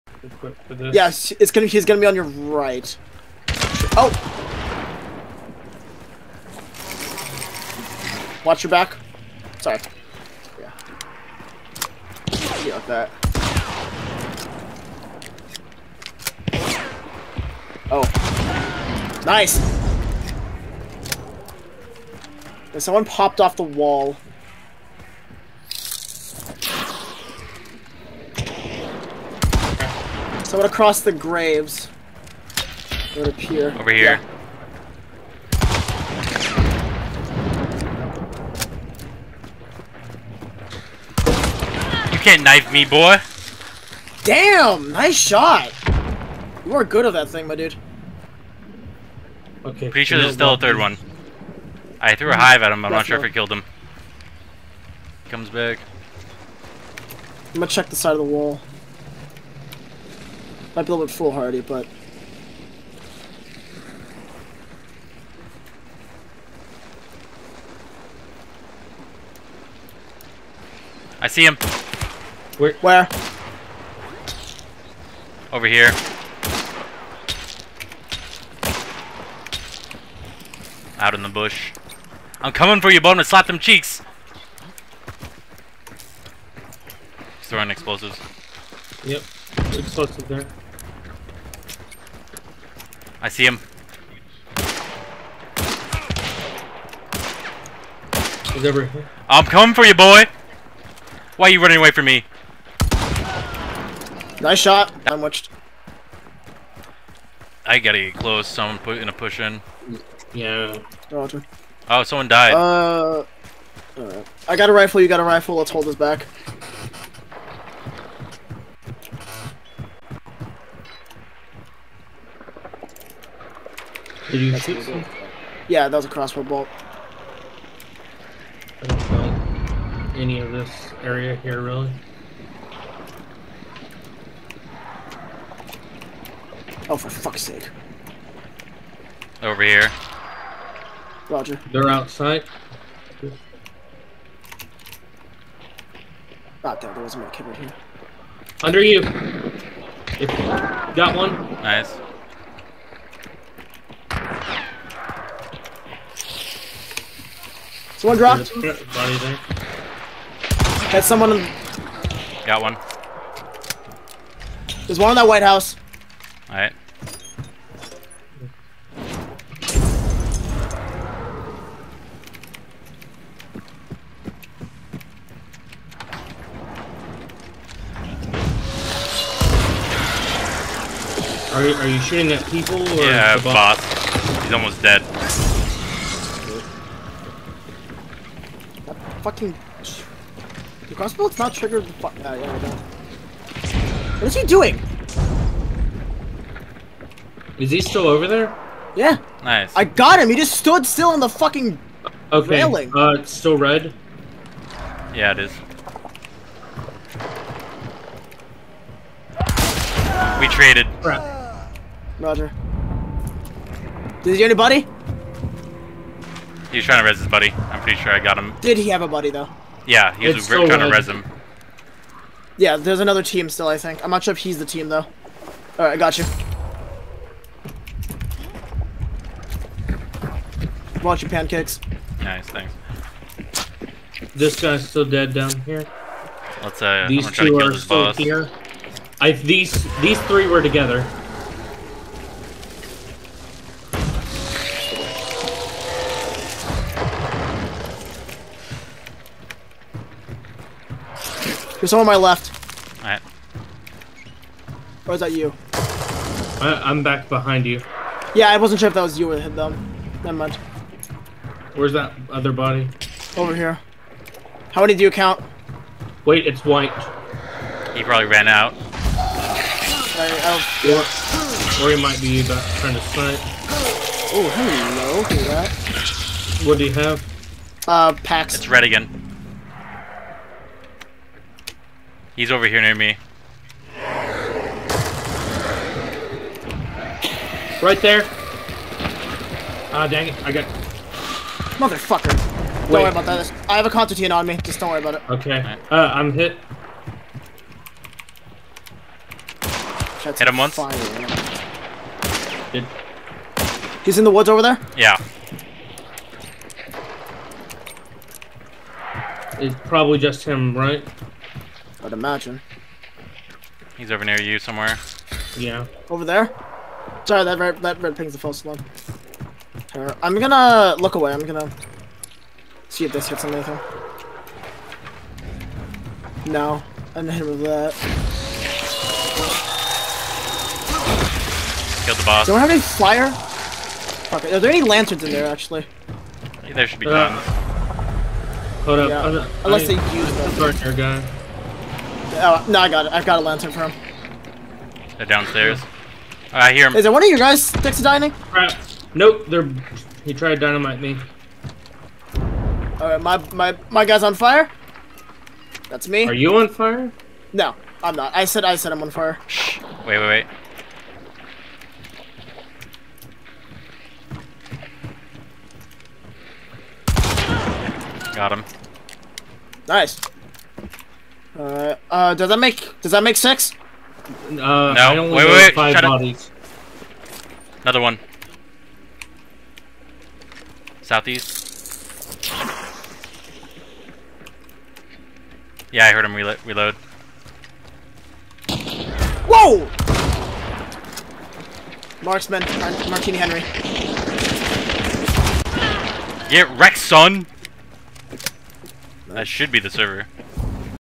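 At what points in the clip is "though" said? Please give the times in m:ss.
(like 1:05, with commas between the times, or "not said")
3:39, 3:44.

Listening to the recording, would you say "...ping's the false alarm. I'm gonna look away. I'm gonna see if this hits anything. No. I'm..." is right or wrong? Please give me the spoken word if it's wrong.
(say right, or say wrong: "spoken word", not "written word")
right.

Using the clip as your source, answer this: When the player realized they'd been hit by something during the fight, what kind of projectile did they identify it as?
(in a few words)
Crossbow bolt.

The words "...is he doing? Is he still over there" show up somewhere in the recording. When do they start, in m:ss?
3:14.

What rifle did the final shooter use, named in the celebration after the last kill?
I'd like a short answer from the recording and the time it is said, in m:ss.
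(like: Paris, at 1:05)
Martini Henry, at 6:33.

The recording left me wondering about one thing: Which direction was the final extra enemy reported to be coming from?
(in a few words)
Southeast.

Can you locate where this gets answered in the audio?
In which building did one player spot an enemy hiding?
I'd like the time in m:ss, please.
2:45.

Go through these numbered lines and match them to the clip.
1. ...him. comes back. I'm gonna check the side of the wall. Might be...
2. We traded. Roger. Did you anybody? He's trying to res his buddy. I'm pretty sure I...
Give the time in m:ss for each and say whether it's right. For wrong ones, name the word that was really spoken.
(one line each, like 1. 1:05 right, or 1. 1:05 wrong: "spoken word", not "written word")
1. 0:53 right
2. 3:30 right.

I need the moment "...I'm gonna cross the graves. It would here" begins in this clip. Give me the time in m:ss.
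0:30.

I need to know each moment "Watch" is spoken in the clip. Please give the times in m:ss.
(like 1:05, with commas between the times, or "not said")
0:08, 3:51.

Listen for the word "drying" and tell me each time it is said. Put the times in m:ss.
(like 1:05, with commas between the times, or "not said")
not said.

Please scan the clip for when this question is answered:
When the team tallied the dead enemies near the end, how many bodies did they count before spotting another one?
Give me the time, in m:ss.
6:15.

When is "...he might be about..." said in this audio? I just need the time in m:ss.
4:31.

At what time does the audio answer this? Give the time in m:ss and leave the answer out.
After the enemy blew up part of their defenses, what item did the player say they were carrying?
4:53.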